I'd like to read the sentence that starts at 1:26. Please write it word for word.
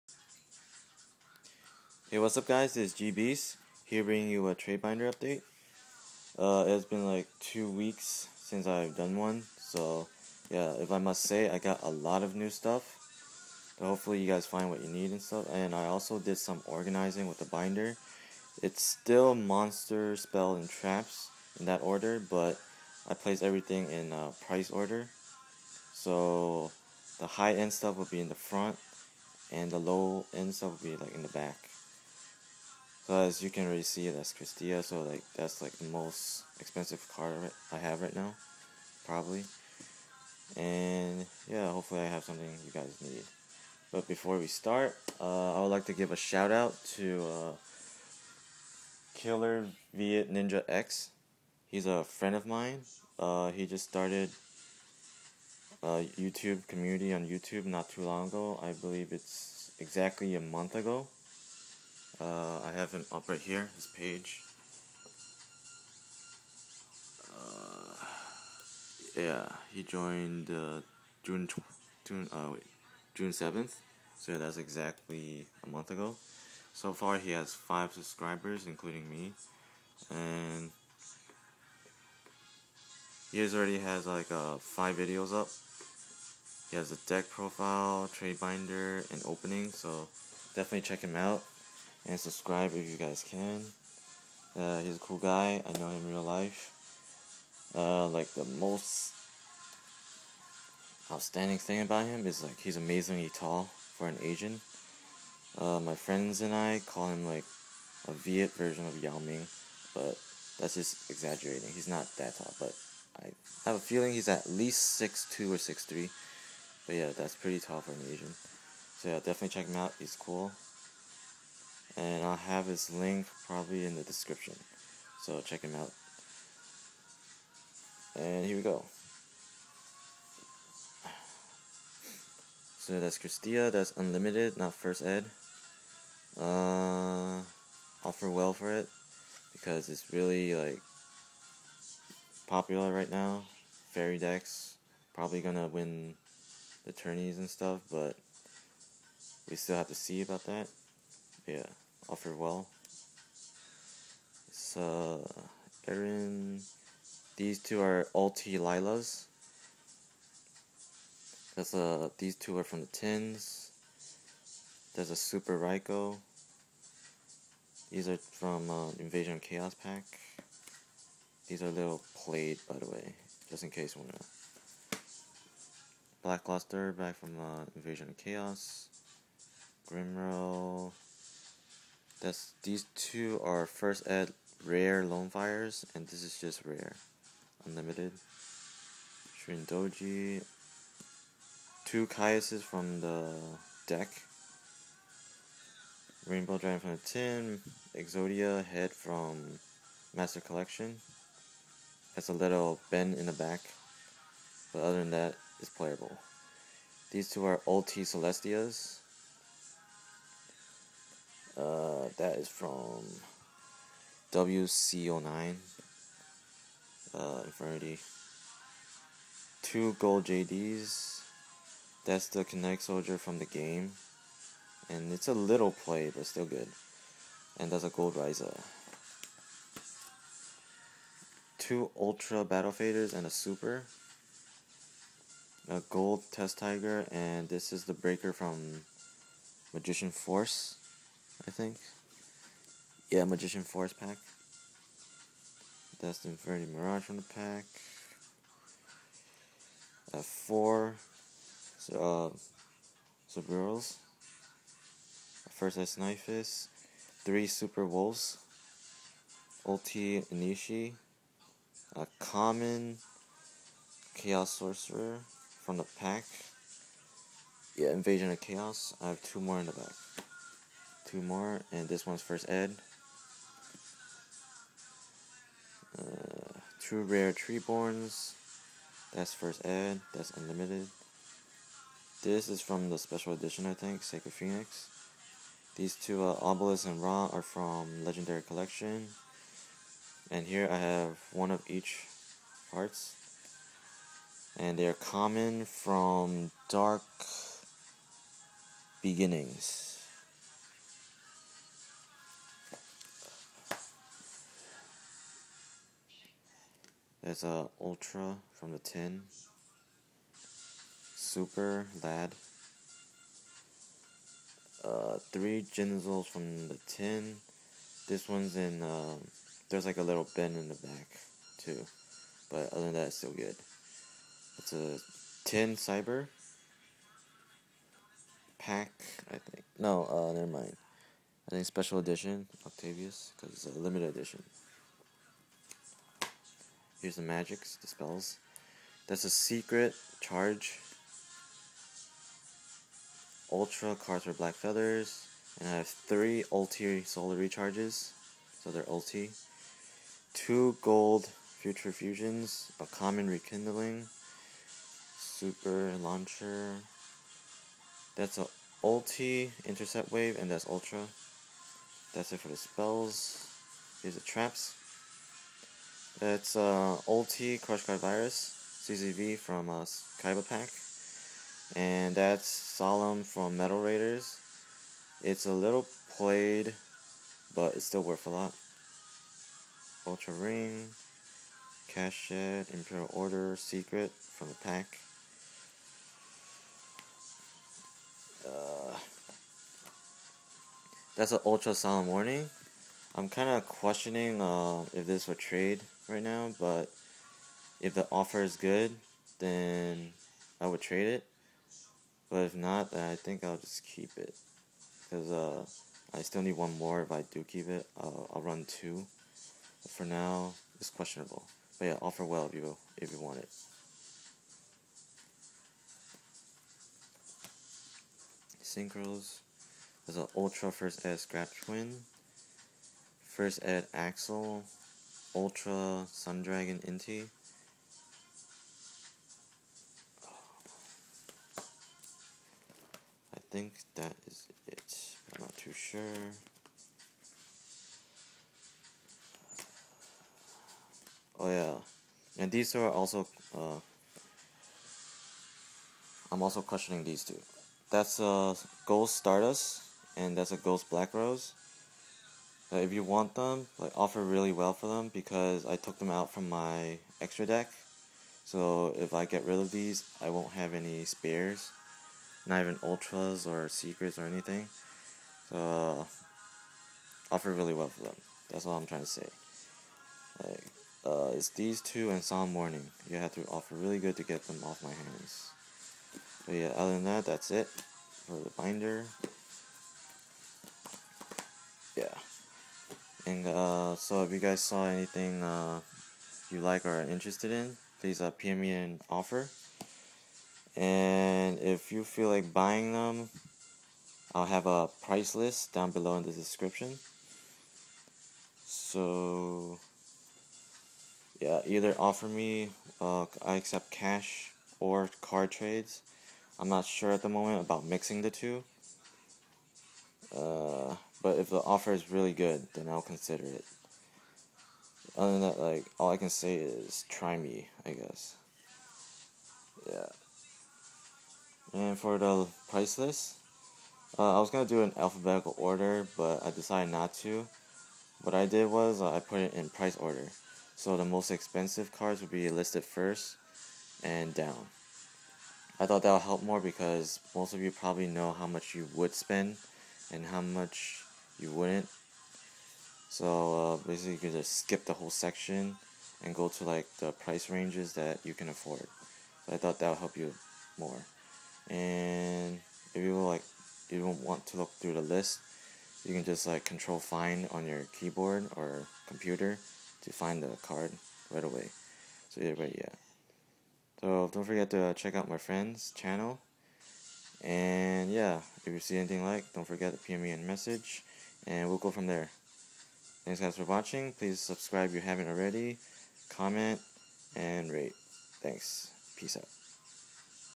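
He has a deck profile, trade binder, and opening.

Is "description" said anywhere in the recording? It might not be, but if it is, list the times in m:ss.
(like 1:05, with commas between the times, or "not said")
2:04, 8:16.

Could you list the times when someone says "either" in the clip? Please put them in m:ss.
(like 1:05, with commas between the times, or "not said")
8:21, 9:22.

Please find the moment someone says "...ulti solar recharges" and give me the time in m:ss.
5:46.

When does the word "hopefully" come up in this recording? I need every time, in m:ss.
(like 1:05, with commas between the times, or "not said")
0:13, 0:41.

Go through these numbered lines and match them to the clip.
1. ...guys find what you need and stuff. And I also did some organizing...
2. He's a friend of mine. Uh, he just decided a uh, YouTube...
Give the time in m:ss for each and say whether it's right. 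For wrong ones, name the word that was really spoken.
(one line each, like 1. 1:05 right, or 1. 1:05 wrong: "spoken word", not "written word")
1. 0:14 right
2. 0:51 wrong: "started", not "decided".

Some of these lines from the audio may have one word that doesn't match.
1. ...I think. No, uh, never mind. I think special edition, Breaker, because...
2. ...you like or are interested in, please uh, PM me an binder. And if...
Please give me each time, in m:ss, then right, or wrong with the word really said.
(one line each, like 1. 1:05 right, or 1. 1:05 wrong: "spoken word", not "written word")
1. 5:29 wrong: "Octavius", not "Breaker"
2. 8:06 wrong: "offer", not "binder".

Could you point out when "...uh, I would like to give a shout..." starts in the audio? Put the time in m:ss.
0:45.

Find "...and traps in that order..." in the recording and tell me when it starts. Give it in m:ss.
0:20.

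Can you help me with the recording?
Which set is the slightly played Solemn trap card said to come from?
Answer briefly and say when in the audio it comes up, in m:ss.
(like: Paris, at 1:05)
Metal Raiders, at 6:13.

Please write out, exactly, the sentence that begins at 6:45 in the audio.
Because uh, I still need one more.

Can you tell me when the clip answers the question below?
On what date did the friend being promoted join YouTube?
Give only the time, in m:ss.
1:13.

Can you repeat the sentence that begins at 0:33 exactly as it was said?
So as you can already see, that's Kristya.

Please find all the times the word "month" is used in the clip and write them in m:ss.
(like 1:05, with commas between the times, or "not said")
1:00, 1:15.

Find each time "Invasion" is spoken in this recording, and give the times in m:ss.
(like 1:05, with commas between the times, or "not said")
2:48, 2:57, 4:27.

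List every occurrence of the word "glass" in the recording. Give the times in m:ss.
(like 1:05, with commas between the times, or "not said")
not said.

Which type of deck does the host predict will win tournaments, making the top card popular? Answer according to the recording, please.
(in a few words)
Fairy decks.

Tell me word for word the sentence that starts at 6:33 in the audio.
I'm kind of questioning uh, if this would trade right now, but if the offer is good, then I would trade it.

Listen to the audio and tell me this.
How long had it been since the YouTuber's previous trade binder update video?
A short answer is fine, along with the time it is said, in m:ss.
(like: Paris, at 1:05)
two weeks, at 0:07.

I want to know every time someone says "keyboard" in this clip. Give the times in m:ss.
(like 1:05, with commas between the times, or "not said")
9:17.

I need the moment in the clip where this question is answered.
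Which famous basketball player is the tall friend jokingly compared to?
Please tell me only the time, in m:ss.
1:49.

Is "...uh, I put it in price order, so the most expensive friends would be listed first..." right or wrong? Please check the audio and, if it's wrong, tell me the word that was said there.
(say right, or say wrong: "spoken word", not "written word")
wrong: "cards", not "friends".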